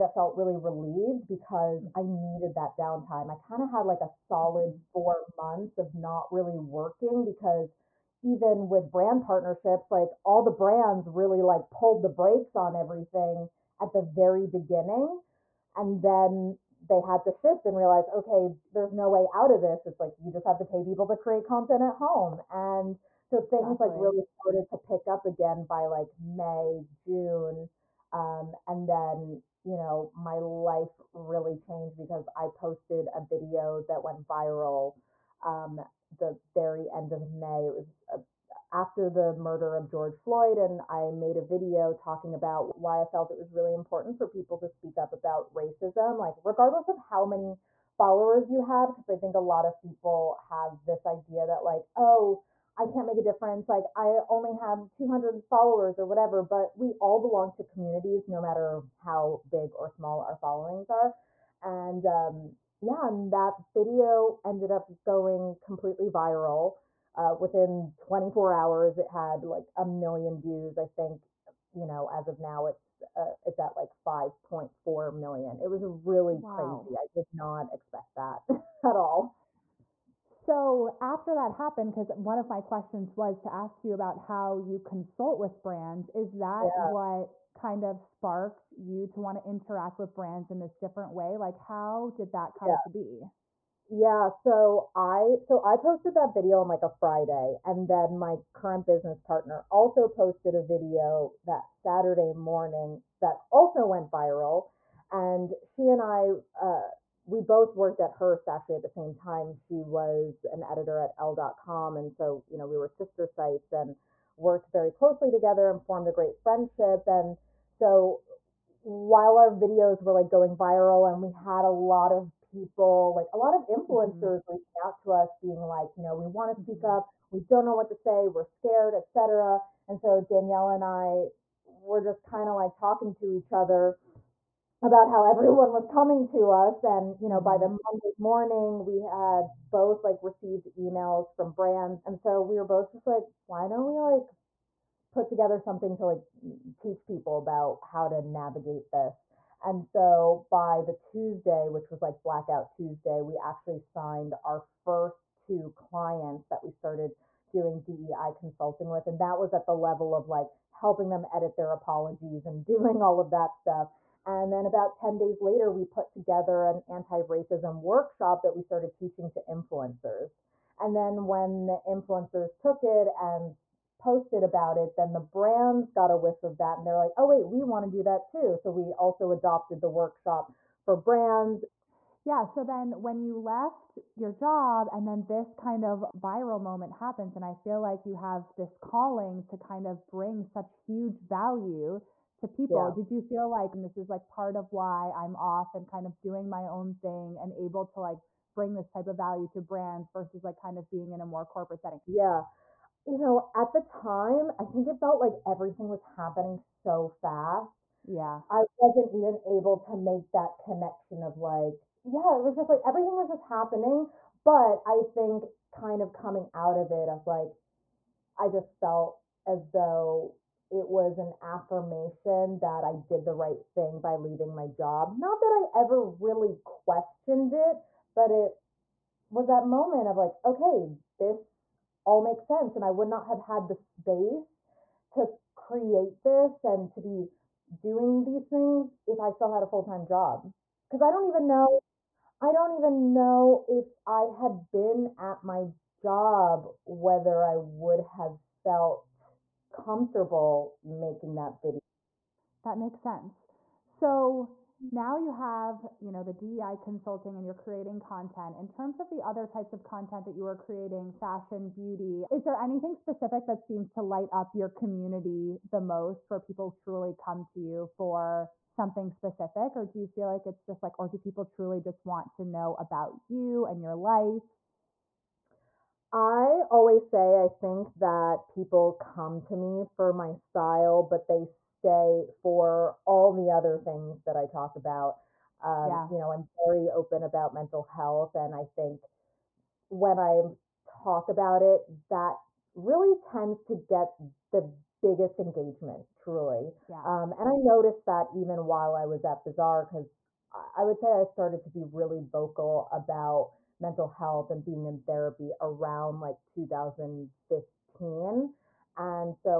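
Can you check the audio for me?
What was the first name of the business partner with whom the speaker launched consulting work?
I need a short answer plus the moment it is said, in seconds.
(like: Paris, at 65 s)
Danielle, at 130 s.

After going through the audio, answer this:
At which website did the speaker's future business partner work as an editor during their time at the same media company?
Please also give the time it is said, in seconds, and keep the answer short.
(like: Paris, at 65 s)
Elle.com, at 111 s.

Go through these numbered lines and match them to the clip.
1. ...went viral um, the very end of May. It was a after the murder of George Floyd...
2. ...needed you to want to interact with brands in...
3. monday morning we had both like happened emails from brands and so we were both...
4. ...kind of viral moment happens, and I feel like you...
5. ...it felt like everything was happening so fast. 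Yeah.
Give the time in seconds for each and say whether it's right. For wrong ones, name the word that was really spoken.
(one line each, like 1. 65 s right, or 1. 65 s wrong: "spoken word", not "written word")
1. 34 s right
2. 87 s wrong: "sparked", not "needed"
3. 137 s wrong: "received", not "happened"
4. 185 s right
5. 204 s right.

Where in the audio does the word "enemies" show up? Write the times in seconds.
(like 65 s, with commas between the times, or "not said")
not said.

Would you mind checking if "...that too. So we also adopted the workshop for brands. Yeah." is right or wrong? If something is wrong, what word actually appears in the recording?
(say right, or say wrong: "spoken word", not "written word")
right.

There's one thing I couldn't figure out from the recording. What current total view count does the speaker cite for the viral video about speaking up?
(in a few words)
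5.4 million.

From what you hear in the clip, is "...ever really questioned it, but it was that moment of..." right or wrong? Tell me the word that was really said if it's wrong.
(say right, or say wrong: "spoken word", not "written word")
right.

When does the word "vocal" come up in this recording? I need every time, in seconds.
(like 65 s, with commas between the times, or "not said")
302 s.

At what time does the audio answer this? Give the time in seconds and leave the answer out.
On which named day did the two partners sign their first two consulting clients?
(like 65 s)
152 s.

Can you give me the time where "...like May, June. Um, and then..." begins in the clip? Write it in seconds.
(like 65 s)
25 s.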